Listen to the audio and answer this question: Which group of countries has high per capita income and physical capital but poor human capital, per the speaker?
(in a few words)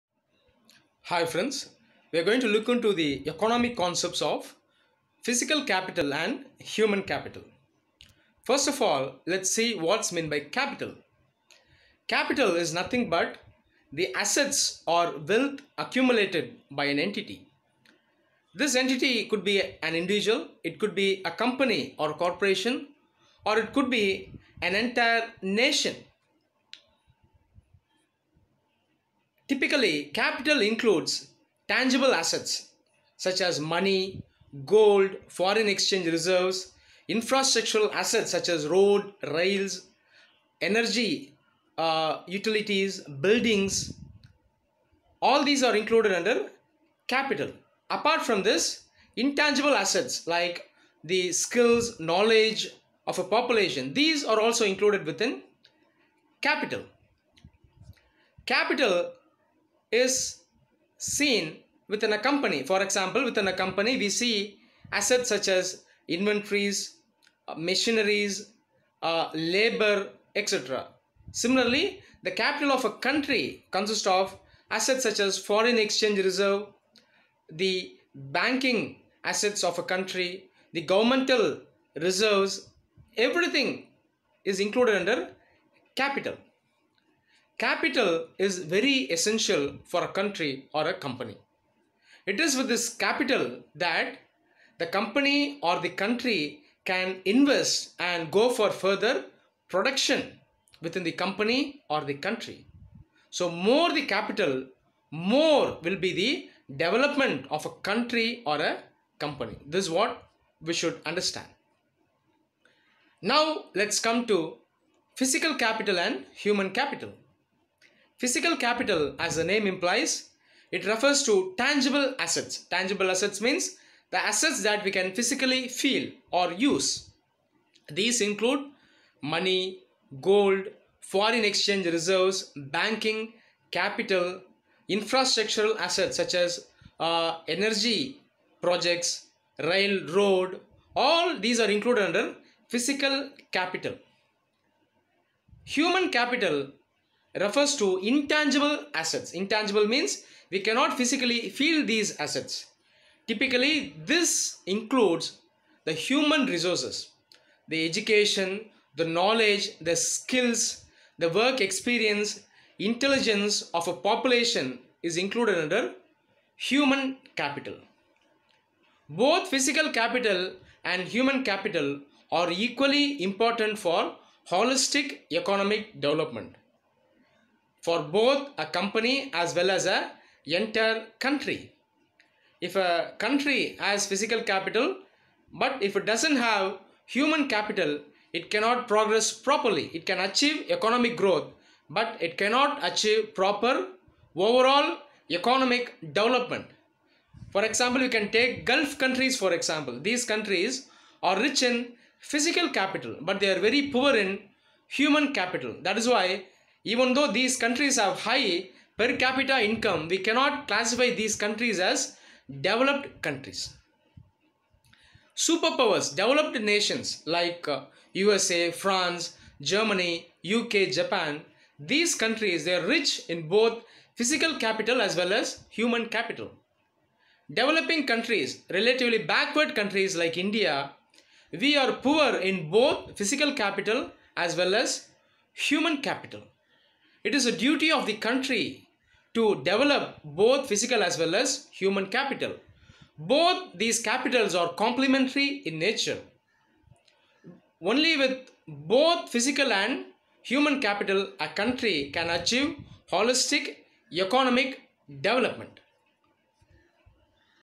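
Gulf countries.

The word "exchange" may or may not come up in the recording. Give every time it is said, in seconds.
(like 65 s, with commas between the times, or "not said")
35 s, 75 s, 131 s.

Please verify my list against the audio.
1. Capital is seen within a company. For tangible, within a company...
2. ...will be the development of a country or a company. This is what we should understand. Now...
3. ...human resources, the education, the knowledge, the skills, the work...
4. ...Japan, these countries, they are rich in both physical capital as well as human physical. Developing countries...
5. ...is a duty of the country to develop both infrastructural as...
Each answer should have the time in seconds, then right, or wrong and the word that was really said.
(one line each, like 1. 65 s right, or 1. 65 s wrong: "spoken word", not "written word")
1. 58 s wrong: "example", not "tangible"
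2. 105 s right
3. 155 s right
4. 220 s wrong: "capital", not "physical"
5. 237 s wrong: "physical", not "infrastructural".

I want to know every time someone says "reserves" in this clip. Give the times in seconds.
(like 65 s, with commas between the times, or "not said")
36 s, 76 s, 81 s, 131 s.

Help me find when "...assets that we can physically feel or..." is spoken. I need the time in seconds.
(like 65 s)
124 s.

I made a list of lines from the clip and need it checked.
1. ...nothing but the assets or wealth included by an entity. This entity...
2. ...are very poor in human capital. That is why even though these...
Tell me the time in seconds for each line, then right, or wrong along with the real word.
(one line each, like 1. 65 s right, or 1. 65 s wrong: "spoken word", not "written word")
1. 12 s wrong: "accumulated", not "included"
2. 203 s right.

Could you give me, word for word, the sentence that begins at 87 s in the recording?
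Capital is very essential for a country or a company.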